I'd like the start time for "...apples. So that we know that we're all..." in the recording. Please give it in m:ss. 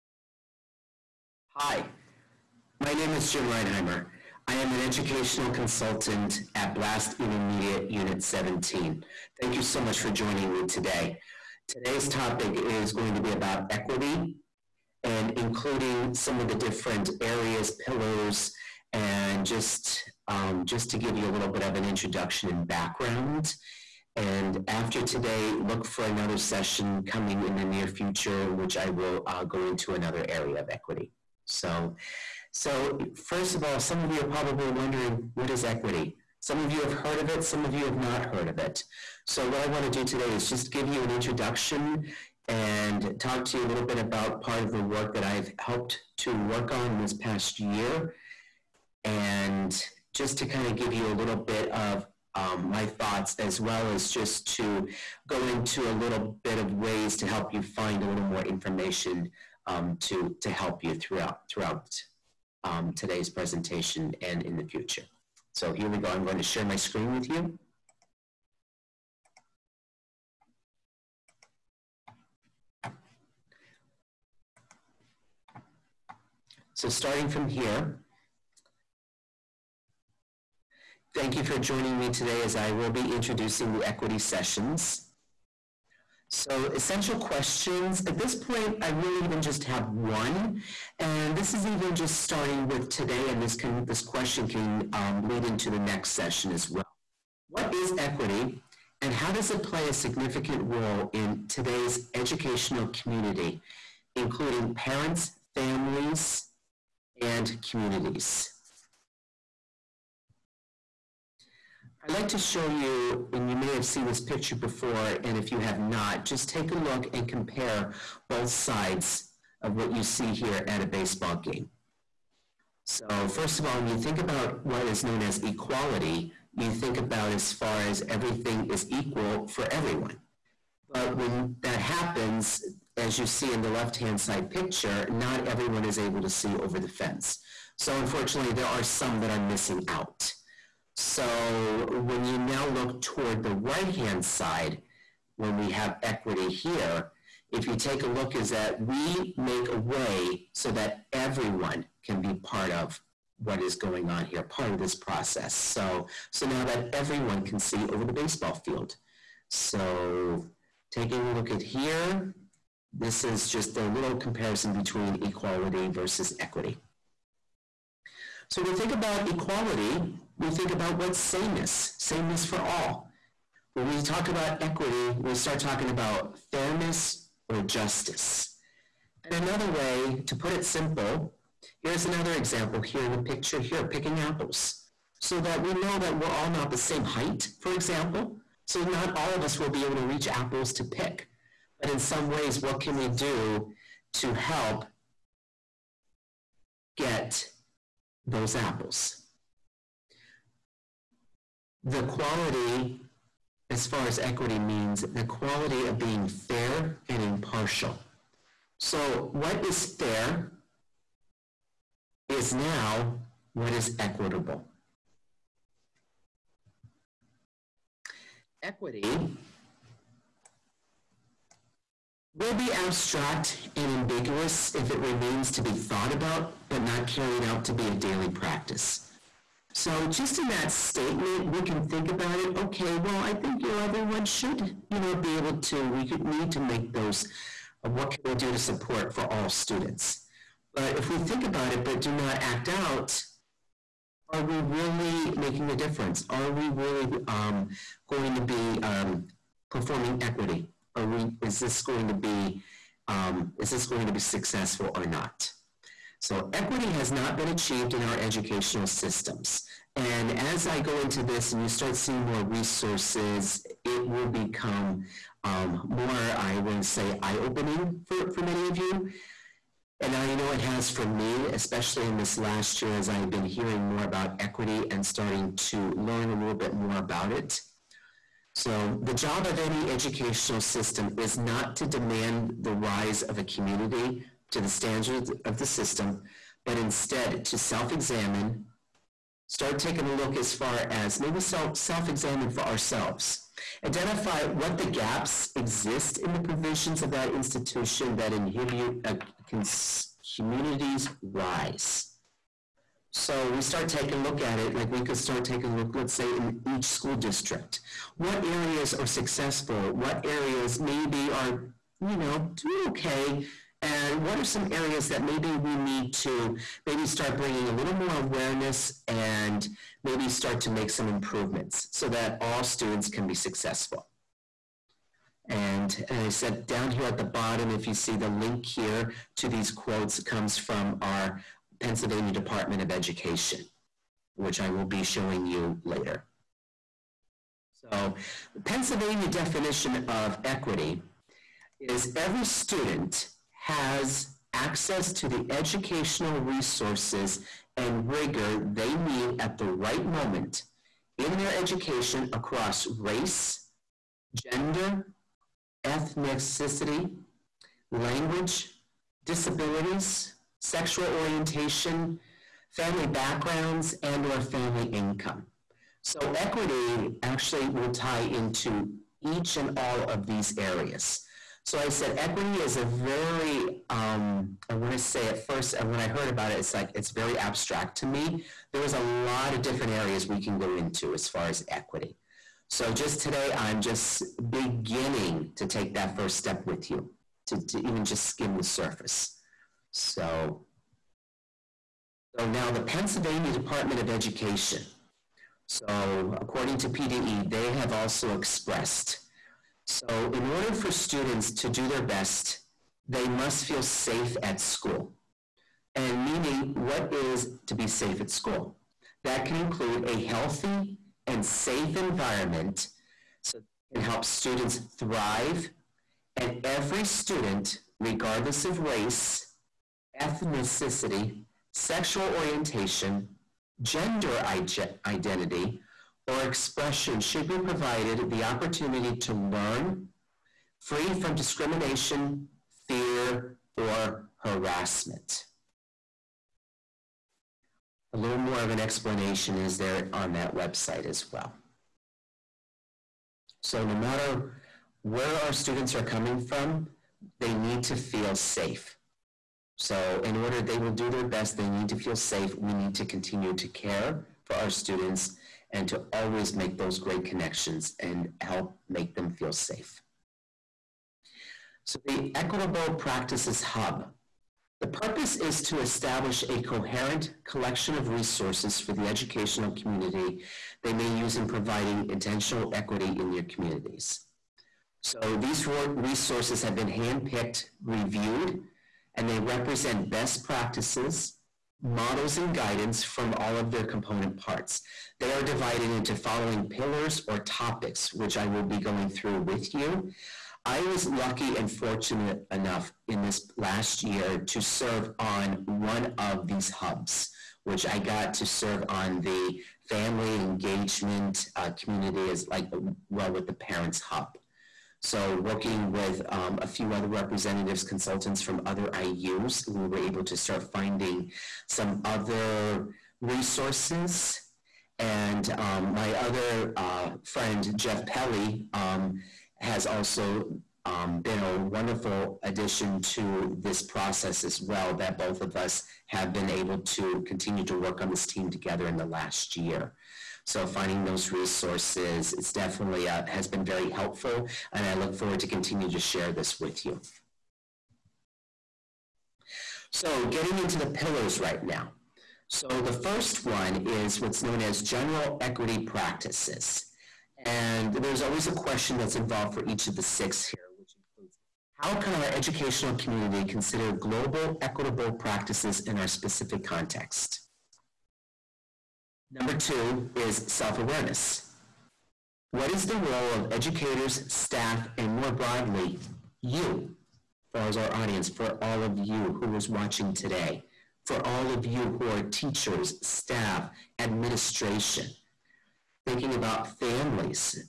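3:04.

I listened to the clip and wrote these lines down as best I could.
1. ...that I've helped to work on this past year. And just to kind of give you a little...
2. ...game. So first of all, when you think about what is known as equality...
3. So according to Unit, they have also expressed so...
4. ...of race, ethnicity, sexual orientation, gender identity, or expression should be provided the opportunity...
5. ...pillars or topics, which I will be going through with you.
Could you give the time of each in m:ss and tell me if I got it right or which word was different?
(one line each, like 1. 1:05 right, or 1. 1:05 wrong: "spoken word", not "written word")
1. 0:45 right
2. 2:01 right
3. 6:35 wrong: "PDE", not "Unit"
4. 6:58 right
5. 8:06 right.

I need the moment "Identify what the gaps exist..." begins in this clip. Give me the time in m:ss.
4:53.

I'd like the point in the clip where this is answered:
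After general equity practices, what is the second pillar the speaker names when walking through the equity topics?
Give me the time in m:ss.
9:20.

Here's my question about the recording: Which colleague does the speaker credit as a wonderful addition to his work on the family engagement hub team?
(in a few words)
Jeff Pelly.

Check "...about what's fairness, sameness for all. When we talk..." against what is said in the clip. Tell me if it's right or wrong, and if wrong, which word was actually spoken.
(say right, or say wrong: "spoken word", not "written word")
wrong: "sameness", not "fairness".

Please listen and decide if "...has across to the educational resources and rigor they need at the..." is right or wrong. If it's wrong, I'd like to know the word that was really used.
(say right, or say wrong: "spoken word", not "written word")
wrong: "access", not "across".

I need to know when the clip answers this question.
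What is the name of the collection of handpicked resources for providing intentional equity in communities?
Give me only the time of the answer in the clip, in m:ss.
7:42.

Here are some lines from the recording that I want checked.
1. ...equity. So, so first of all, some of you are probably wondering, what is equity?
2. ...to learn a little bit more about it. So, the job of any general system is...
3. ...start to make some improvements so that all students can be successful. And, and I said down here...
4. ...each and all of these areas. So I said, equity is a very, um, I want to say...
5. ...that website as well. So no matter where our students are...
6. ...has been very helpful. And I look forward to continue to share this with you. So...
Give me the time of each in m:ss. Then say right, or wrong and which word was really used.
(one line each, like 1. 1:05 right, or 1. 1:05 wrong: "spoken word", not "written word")
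1. 0:30 right
2. 4:35 wrong: "educational", not "general"
3. 5:20 right
4. 6:09 right
5. 7:20 right
6. 8:53 right.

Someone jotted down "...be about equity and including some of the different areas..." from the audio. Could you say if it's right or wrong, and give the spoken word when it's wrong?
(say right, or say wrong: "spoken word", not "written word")
right.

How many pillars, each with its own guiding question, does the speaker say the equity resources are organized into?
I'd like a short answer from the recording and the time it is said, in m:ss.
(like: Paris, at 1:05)
6, at 9:10.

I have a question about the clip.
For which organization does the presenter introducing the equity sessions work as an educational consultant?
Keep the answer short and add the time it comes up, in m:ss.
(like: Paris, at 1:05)
Blast Intermediate Unit 17, at 0:06.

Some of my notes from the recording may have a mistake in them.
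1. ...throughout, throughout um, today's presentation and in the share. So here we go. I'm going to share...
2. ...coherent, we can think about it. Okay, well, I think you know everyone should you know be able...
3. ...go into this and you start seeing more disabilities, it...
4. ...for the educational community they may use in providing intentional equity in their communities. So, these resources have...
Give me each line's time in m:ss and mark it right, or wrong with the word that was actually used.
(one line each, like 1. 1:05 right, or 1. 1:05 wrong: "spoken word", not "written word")
1. 1:00 wrong: "future", not "share"
2. 3:50 wrong: "statement", not "coherent"
3. 4:20 wrong: "resources", not "disabilities"
4. 7:48 right.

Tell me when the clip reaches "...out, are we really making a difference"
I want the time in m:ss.
4:02.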